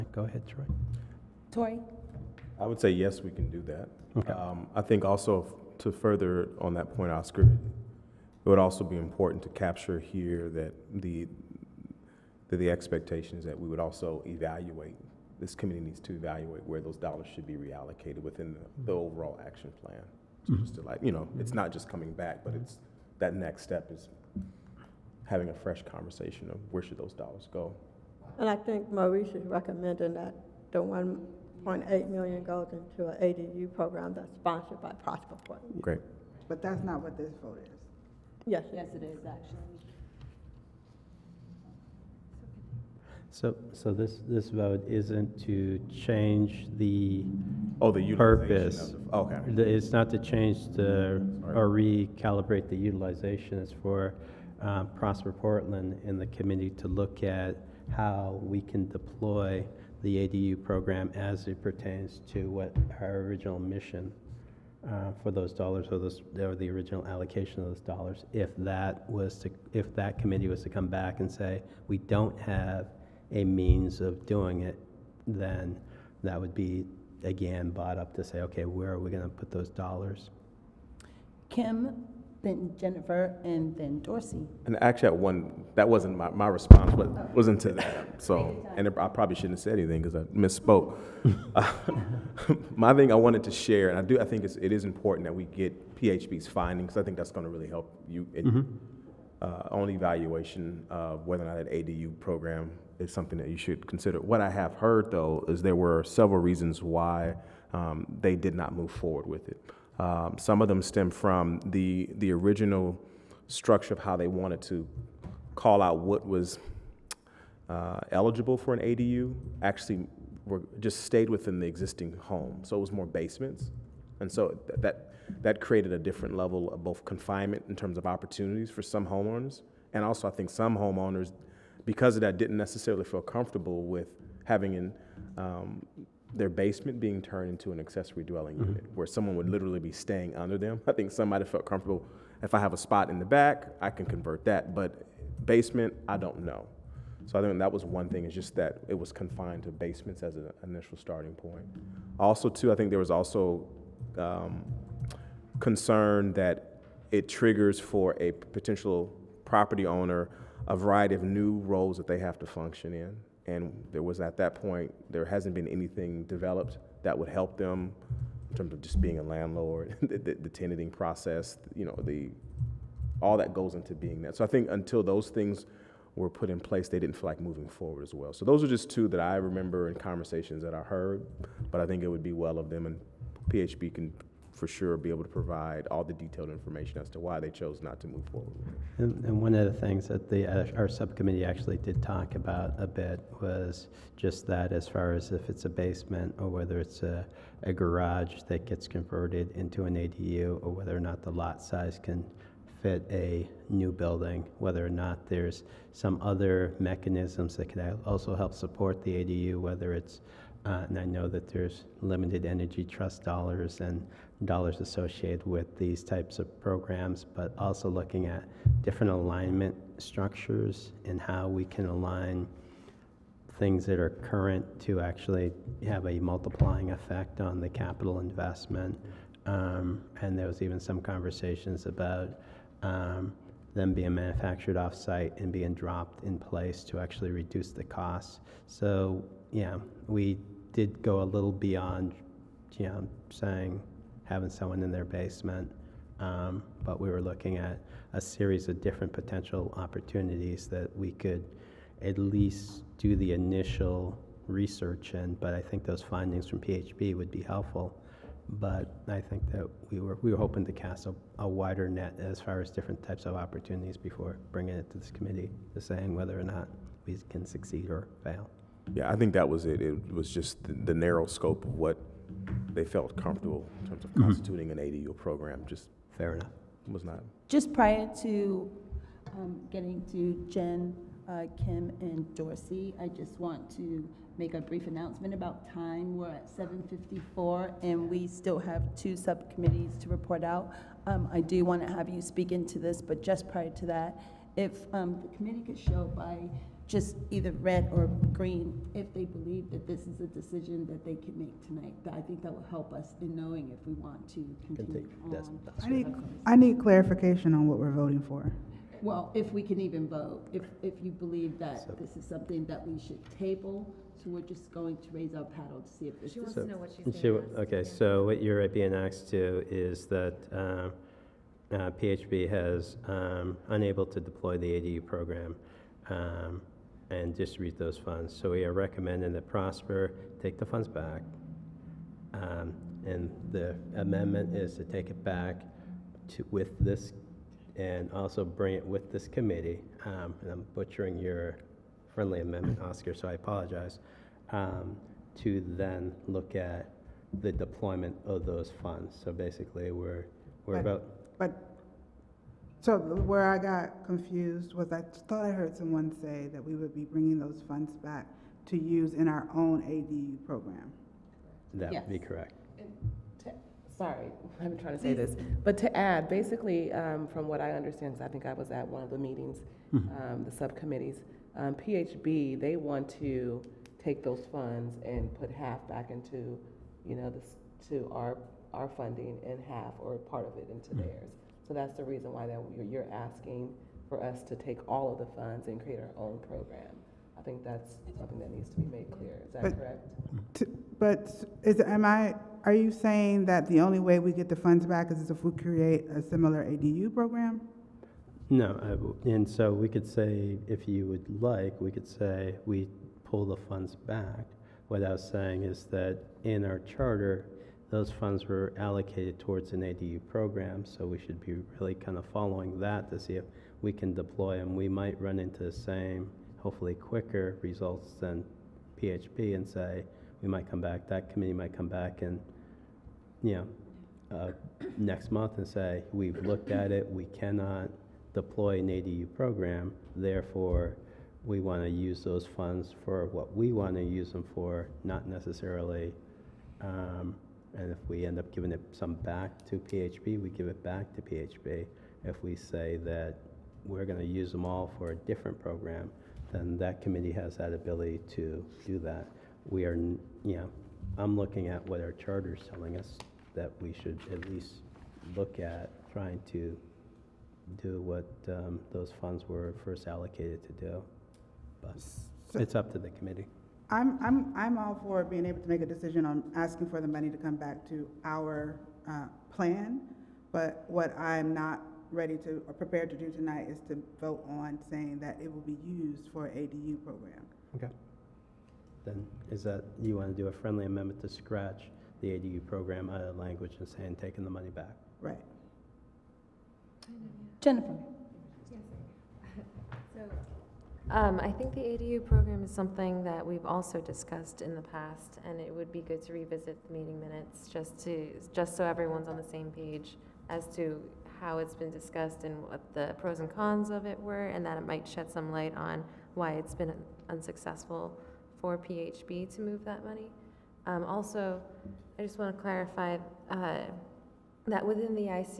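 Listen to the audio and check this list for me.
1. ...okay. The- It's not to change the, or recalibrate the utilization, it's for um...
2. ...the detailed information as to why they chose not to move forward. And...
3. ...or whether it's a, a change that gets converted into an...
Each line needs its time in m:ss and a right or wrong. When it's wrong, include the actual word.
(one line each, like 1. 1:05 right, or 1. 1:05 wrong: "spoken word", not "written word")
1. 0:49 right
2. 3:06 right
3. 3:16 wrong: "garage", not "change".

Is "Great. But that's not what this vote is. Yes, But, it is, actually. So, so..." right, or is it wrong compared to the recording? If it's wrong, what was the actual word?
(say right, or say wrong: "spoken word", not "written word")
wrong: "Yes", not "But".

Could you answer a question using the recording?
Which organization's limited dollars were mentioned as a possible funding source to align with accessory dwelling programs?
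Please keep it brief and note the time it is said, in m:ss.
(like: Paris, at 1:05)
Energy Trust, at 3:32.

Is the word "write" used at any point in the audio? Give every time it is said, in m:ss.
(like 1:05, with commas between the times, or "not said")
not said.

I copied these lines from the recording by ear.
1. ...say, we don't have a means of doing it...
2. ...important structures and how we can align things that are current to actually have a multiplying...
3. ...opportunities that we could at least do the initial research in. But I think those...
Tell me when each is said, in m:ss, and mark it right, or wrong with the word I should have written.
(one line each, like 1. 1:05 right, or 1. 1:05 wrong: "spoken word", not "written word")
1. 1:11 right
2. 3:39 wrong: "alignment", not "important"
3. 4:09 right.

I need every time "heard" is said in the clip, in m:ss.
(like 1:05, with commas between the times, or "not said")
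1:44, 3:00, 5:55.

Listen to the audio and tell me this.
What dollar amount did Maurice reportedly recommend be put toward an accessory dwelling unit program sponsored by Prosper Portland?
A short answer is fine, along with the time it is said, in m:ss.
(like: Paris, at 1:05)
1.8 million, at 0:30.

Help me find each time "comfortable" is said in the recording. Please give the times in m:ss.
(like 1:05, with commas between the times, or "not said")
2:13, 2:21, 4:33.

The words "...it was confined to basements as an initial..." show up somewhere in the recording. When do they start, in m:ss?
2:28.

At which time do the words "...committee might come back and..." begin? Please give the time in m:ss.
7:01.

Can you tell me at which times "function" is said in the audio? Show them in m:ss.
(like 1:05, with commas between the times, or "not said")
2:42.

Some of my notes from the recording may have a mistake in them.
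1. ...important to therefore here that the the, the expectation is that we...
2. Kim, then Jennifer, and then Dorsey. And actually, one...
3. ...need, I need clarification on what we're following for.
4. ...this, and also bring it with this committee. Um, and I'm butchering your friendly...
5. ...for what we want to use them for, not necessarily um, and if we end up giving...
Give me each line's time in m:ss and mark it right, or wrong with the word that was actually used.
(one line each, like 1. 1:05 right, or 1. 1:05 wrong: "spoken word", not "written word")
1. 0:08 wrong: "capture", not "therefore"
2. 1:21 right
3. 5:05 wrong: "voting", not "following"
4. 5:36 right
5. 7:13 right.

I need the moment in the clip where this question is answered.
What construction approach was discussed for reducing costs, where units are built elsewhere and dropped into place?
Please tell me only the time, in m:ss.
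3:54.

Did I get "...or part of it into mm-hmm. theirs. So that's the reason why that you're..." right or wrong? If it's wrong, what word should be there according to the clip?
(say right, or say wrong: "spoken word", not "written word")
right.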